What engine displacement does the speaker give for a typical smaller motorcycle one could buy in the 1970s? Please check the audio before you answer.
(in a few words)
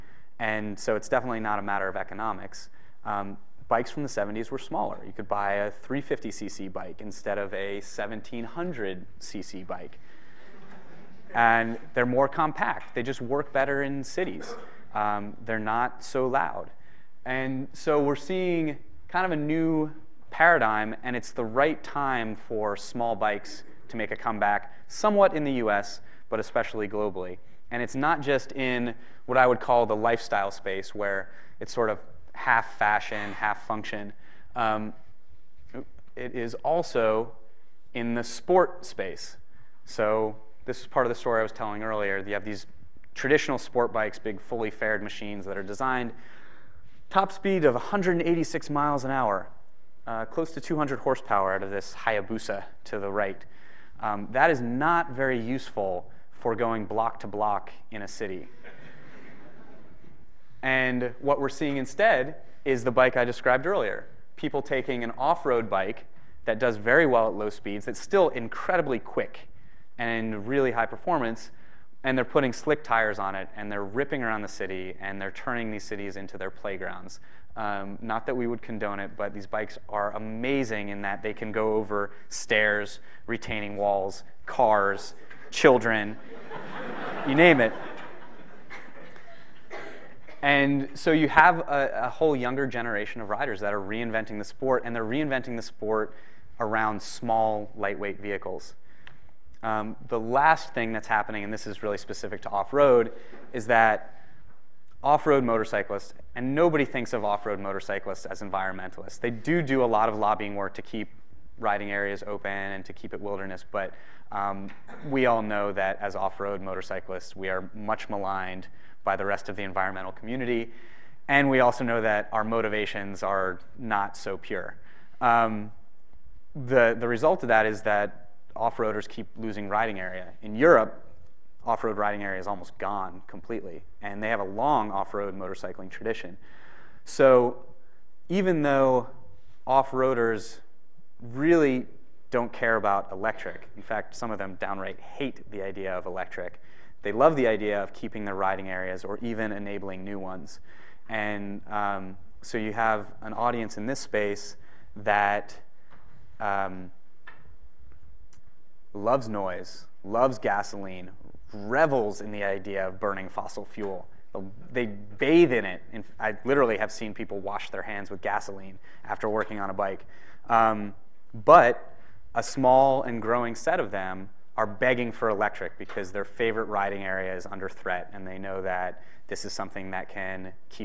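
350cc.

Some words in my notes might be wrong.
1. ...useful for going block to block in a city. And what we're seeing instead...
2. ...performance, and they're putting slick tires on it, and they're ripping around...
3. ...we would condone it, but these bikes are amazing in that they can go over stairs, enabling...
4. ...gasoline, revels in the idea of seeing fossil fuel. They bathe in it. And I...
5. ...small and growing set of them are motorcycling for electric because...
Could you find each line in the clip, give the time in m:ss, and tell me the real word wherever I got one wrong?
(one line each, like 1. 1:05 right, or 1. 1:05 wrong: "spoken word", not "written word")
1. 0:55 right
2. 1:10 right
3. 1:18 wrong: "retaining", not "enabling"
4. 2:40 wrong: "burning", not "seeing"
5. 2:52 wrong: "begging", not "motorcycling".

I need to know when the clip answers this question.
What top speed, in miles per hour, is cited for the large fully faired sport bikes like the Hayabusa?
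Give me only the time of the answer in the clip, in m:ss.
0:47.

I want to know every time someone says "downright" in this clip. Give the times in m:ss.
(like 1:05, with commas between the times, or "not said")
2:24.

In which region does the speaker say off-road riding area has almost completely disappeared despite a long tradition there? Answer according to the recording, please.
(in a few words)
Europe.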